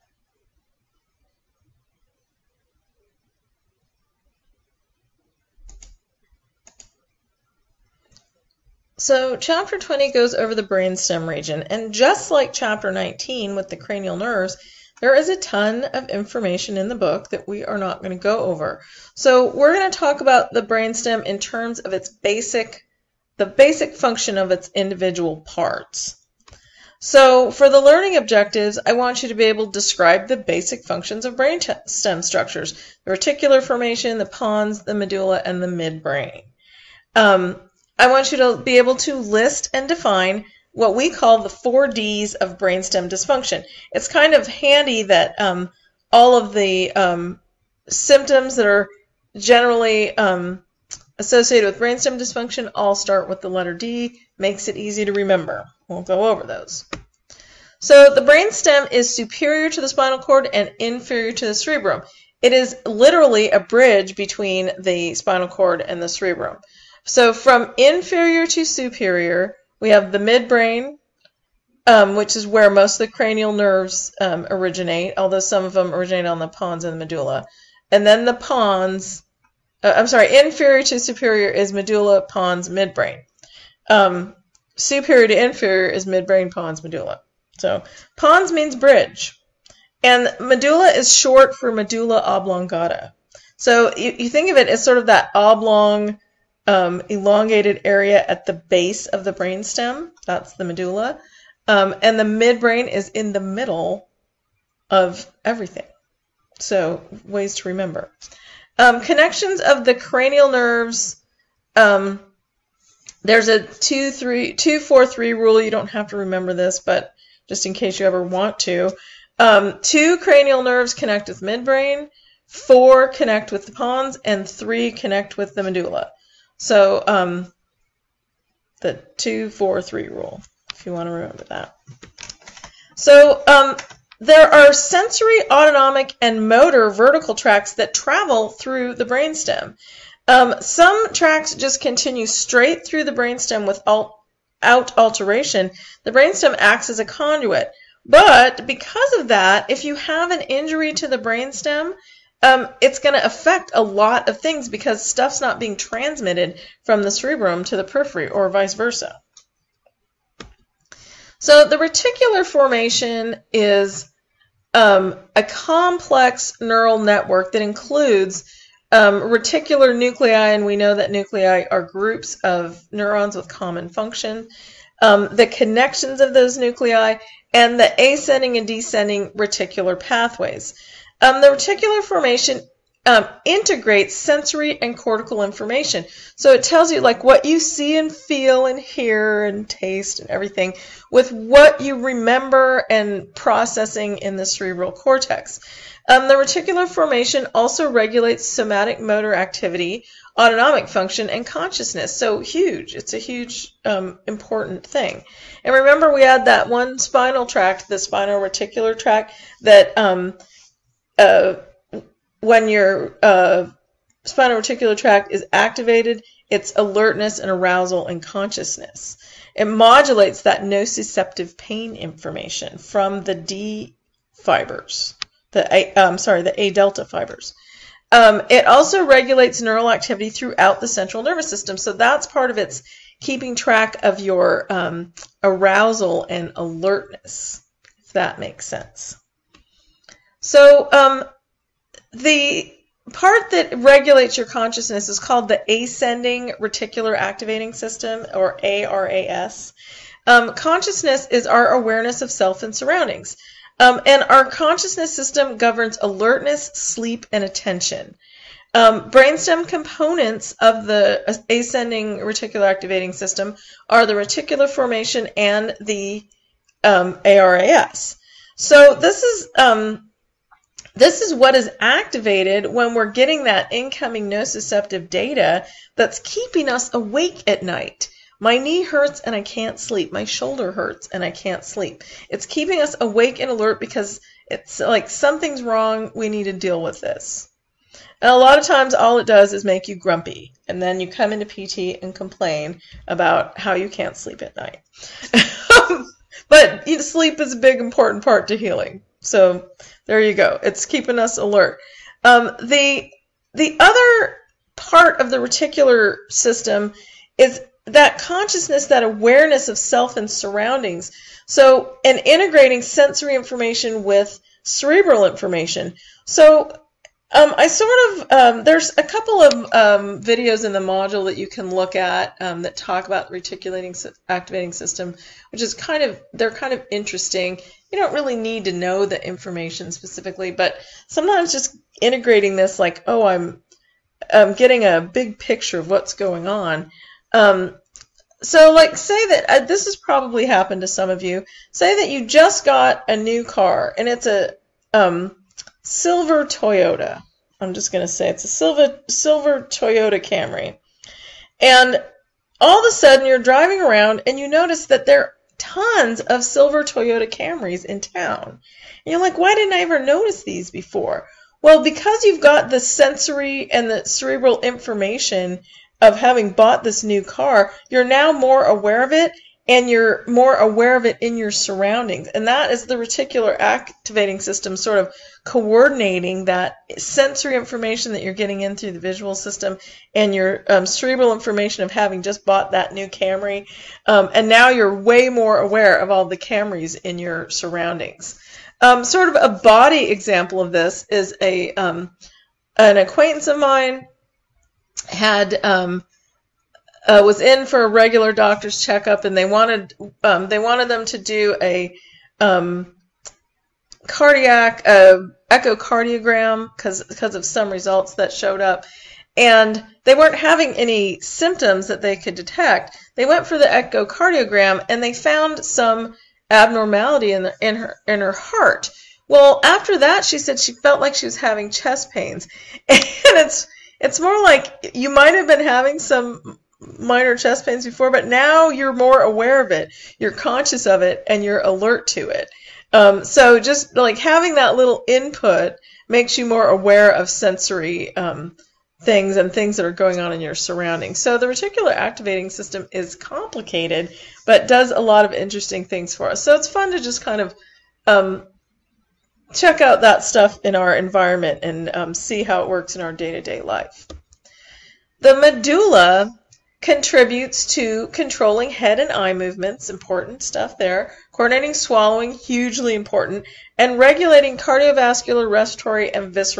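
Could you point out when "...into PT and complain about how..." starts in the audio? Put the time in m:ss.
4:51.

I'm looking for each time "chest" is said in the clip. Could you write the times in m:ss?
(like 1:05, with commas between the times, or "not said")
7:01, 7:07.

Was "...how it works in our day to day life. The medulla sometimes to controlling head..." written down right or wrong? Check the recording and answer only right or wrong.
wrong.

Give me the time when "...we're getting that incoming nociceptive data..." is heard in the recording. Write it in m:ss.
4:32.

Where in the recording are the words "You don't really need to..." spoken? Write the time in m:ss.
5:27.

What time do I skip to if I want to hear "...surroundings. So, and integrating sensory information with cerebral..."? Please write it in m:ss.
5:10.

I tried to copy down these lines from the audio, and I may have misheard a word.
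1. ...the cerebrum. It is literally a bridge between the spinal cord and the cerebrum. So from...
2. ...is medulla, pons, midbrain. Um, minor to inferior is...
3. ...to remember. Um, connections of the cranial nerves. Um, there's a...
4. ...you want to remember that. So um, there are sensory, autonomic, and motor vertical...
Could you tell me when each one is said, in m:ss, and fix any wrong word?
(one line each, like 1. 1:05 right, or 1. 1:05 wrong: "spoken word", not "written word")
1. 1:01 right
2. 1:21 wrong: "superior", not "minor"
3. 1:47 right
4. 2:10 right.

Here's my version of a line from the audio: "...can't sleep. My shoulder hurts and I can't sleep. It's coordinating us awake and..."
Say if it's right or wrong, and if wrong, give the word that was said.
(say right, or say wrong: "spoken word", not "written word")
wrong: "keeping", not "coordinating".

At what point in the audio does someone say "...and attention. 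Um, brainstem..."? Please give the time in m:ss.
4:17.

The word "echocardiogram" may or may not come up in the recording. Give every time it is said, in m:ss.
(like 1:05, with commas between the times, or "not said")
6:45, 6:53.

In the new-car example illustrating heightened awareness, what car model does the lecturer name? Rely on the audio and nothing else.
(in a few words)
Toyota Camry.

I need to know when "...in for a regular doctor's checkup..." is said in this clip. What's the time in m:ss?
6:37.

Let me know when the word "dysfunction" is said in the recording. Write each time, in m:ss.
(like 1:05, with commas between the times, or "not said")
0:43, 0:52.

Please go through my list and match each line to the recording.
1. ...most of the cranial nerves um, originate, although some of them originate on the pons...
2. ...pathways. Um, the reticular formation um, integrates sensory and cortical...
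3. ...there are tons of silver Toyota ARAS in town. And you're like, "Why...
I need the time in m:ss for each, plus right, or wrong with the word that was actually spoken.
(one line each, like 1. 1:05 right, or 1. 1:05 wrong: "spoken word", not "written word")
1. 1:12 right
2. 2:59 right
3. 5:55 wrong: "Camrys", not "ARAS".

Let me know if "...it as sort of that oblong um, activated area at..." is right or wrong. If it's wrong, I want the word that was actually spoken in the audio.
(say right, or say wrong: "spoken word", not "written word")
wrong: "elongated", not "activated".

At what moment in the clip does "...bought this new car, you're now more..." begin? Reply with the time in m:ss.
6:06.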